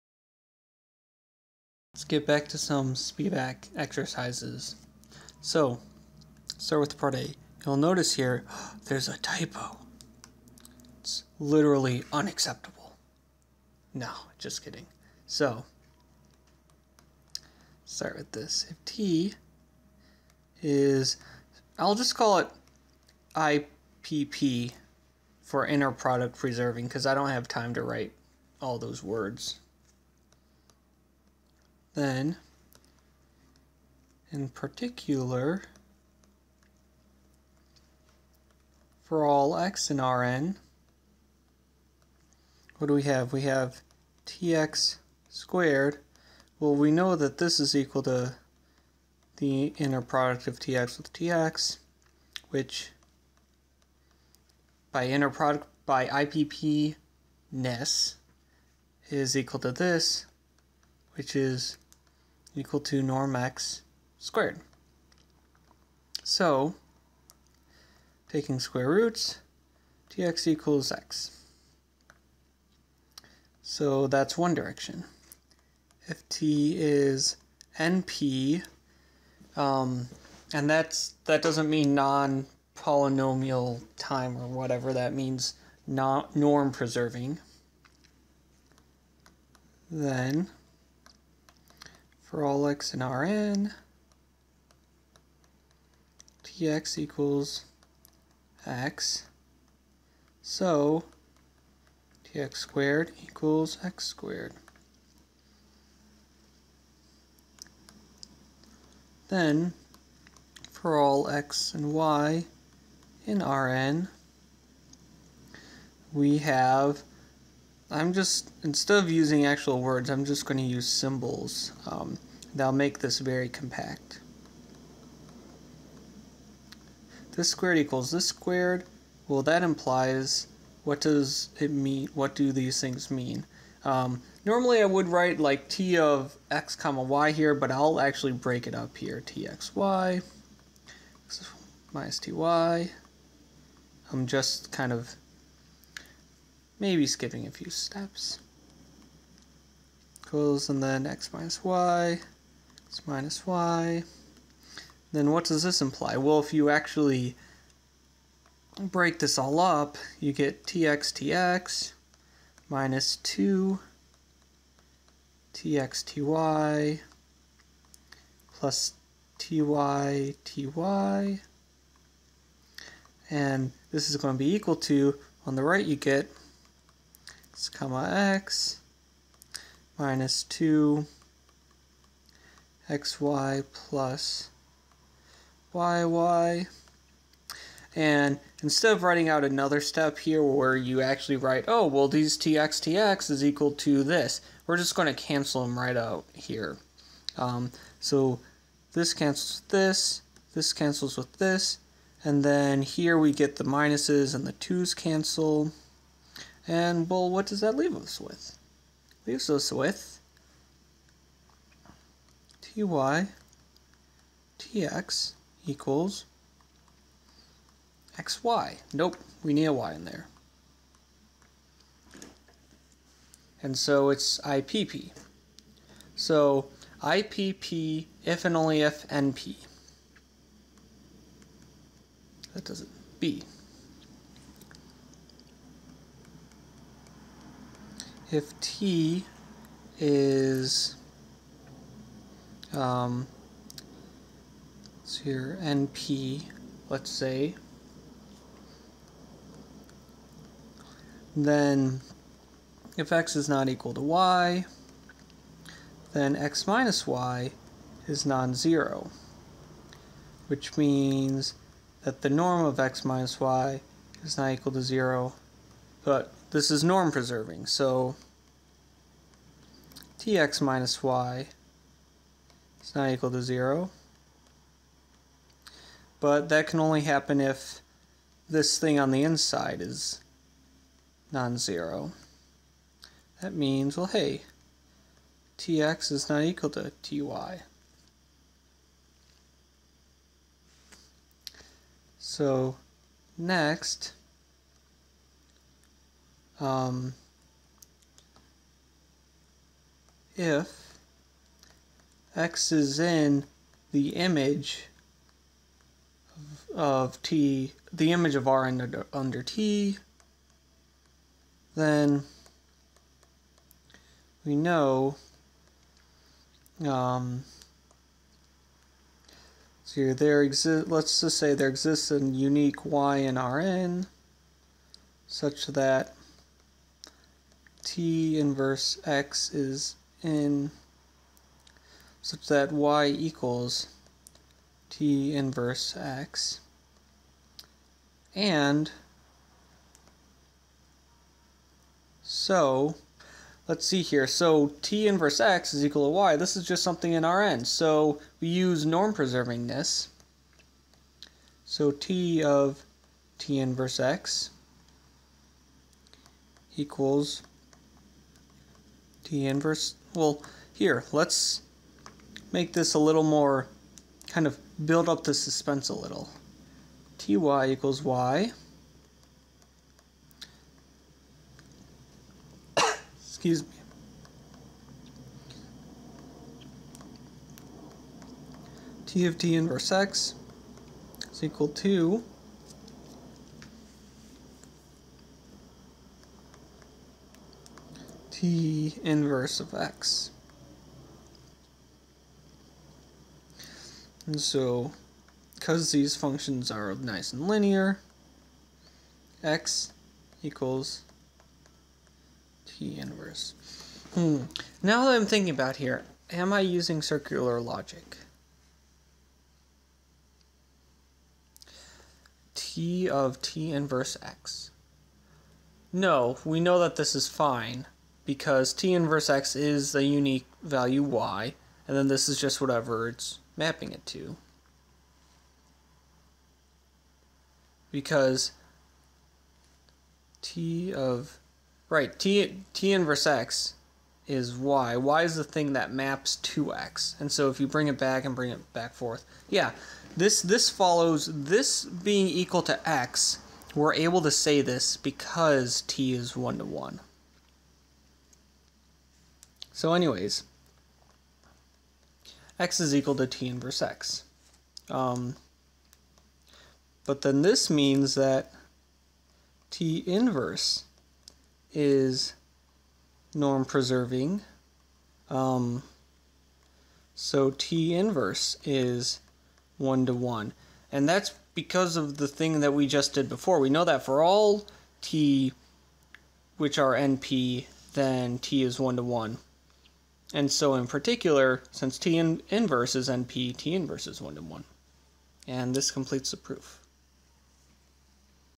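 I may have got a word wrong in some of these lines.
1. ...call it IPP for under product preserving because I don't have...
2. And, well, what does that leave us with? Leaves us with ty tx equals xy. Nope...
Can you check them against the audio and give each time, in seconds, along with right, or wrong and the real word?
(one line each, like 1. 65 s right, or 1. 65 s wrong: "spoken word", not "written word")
1. 22 s wrong: "inner", not "under"
2. 206 s right.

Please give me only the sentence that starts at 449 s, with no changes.
So anyways, x is equal to t inverse x.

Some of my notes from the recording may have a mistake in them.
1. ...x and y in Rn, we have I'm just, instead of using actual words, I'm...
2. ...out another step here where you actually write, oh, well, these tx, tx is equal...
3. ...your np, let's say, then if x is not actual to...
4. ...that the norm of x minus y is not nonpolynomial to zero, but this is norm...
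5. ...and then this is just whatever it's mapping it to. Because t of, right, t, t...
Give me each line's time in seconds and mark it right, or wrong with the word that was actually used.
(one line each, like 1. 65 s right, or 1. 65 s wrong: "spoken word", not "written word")
1. 111 s right
2. 189 s right
3. 245 s wrong: "equal", not "actual"
4. 262 s wrong: "equal", not "nonpolynomial"
5. 421 s right.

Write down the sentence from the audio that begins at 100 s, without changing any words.
So tx squared equals x squared.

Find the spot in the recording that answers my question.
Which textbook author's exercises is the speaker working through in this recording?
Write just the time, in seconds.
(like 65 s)
2 s.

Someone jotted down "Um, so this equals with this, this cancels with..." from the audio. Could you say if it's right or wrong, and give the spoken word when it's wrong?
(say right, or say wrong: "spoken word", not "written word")
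wrong: "cancels", not "equals".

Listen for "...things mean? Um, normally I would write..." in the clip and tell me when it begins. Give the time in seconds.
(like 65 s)
132 s.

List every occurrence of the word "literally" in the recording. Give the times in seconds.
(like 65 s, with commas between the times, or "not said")
11 s.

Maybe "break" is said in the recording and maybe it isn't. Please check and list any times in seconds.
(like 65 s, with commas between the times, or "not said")
138 s, 158 s.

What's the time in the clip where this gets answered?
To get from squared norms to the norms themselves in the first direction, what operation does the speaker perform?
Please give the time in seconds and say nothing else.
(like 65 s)
68 s.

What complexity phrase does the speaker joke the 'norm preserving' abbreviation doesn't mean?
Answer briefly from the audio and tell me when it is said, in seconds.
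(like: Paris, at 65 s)
non-polynomial time, at 81 s.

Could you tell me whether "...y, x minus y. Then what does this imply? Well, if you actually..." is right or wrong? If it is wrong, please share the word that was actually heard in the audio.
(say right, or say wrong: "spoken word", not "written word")
right.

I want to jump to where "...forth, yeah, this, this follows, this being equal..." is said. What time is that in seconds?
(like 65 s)
438 s.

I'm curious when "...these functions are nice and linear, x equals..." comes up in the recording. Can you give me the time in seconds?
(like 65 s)
395 s.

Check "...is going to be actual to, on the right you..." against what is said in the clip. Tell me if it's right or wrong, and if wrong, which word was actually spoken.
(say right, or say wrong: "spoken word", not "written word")
wrong: "equal", not "actual".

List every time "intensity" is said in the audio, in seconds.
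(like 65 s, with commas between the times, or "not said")
not said.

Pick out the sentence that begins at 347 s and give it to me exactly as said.
so we use norm preserving this so t of t inverse x equals the inverse.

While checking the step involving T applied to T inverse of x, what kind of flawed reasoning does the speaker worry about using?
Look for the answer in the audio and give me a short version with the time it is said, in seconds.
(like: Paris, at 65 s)
circular logic, at 407 s.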